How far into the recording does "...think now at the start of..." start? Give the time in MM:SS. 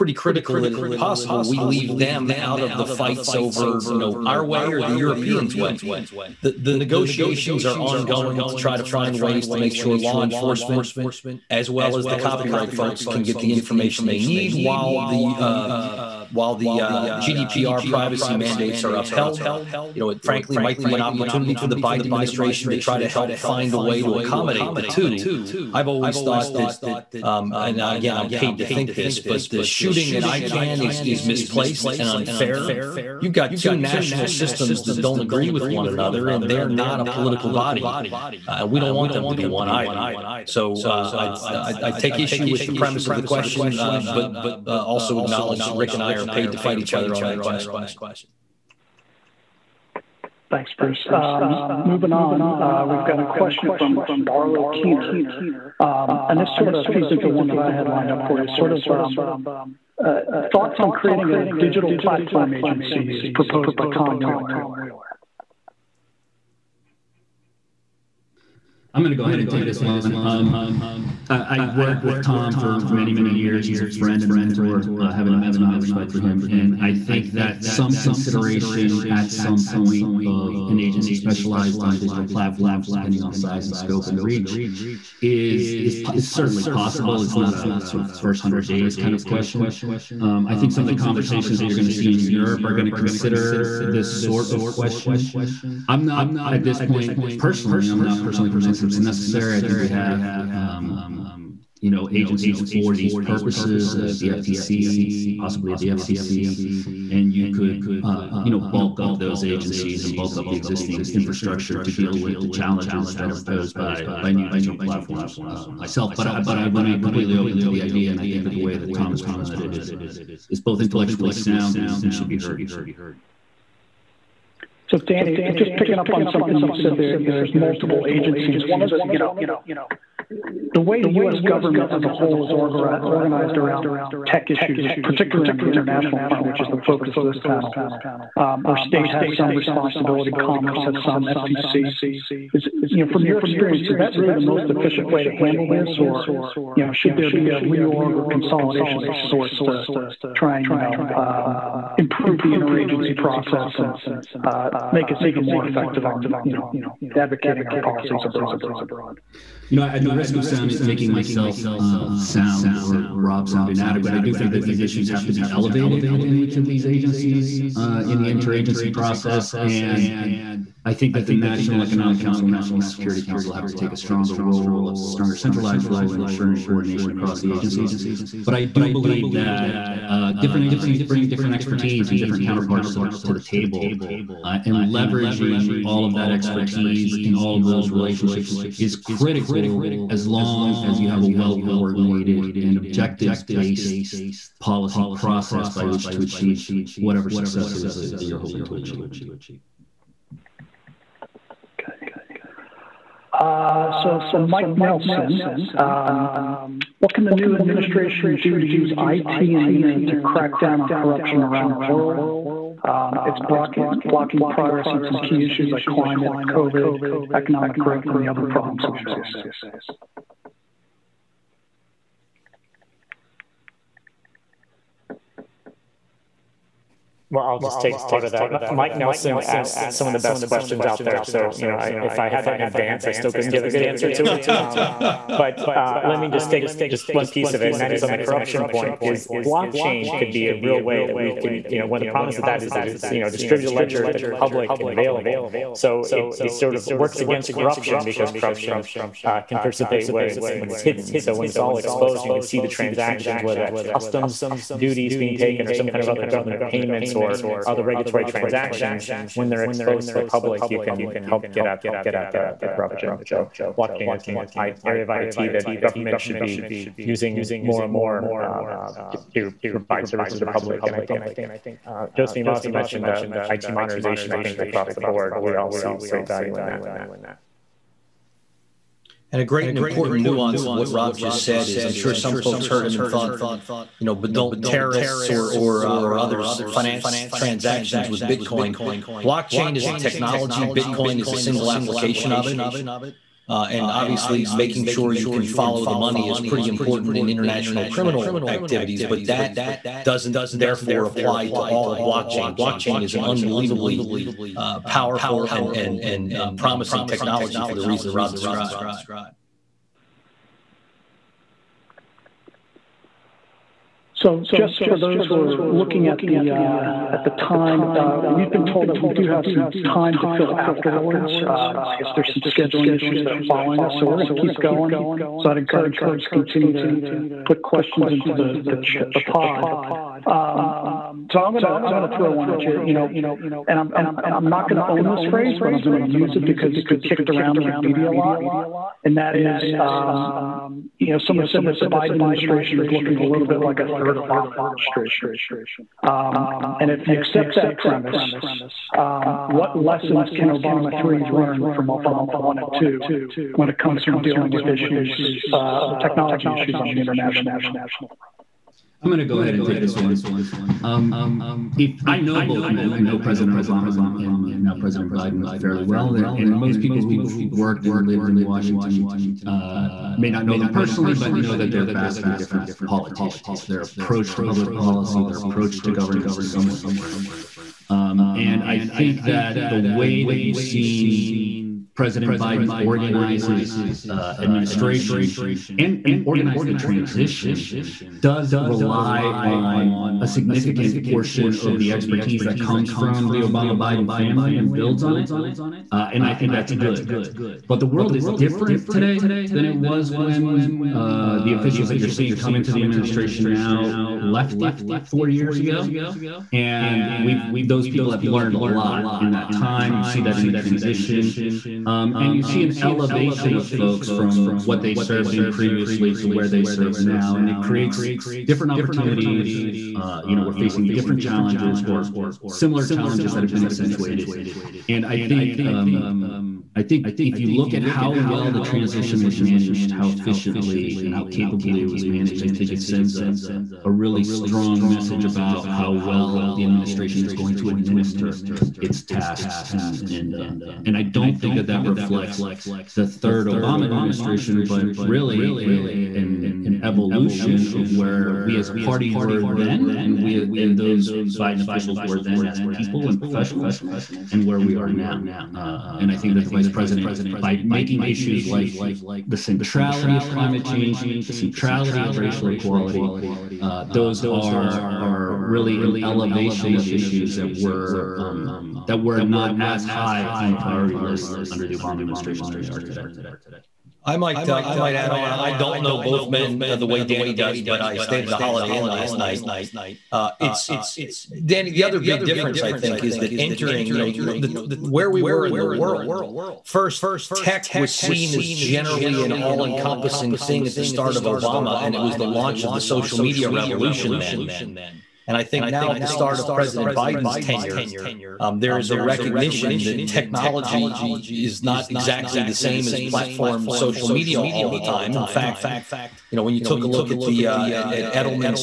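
08:15.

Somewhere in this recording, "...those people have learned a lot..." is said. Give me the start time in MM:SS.
06:47.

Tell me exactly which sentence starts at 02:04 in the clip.
So Danny, just picking up on something you said there, you know, there's multiple agencies.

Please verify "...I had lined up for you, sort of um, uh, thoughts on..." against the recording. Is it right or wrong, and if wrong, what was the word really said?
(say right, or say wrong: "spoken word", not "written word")
right.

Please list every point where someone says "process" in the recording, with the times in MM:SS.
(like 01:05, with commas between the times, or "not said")
02:33, 02:48, 03:15.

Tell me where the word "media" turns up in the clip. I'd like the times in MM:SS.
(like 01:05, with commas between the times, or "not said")
05:37, 08:13, 08:24.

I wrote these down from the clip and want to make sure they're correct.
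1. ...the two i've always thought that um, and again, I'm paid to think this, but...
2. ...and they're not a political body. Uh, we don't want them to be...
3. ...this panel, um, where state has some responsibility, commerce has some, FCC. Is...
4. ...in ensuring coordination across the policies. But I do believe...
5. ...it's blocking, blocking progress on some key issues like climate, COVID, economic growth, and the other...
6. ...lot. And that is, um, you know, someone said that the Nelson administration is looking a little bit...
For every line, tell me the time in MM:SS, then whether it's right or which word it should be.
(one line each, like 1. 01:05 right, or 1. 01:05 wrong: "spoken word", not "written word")
1. 00:24 right
2. 00:36 right
3. 02:17 right
4. 02:56 wrong: "agencies", not "policies"
5. 03:33 right
6. 05:38 wrong: "Biden", not "Nelson".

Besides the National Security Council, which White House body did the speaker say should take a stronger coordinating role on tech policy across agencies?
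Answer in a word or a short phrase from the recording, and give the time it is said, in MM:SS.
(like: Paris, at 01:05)
National Economic Council, at 02:51.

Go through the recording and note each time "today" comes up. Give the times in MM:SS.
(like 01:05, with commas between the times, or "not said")
06:38, 07:52.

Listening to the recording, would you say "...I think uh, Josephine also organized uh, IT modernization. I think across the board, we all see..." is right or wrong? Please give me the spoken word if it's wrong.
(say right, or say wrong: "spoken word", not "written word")
wrong: "mentioned", not "organized".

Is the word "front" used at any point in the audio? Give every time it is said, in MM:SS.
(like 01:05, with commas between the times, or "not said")
02:16, 05:57.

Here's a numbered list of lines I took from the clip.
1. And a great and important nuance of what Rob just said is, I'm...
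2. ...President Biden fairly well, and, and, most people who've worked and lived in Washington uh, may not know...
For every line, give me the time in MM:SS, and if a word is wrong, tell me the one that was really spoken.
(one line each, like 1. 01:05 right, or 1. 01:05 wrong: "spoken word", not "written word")
1. 04:39 right
2. 06:04 right.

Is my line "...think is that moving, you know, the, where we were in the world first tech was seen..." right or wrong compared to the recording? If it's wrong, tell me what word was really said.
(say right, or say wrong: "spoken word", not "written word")
wrong: "entering", not "moving".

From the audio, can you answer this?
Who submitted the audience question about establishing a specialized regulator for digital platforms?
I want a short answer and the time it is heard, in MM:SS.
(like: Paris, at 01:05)
Barlow Keener, at 00:54.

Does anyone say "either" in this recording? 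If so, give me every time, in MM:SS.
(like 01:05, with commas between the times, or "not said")
00:39.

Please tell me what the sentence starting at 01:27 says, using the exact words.
It's not a sort of first hundred days kind of question.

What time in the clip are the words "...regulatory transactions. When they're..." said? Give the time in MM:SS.
04:17.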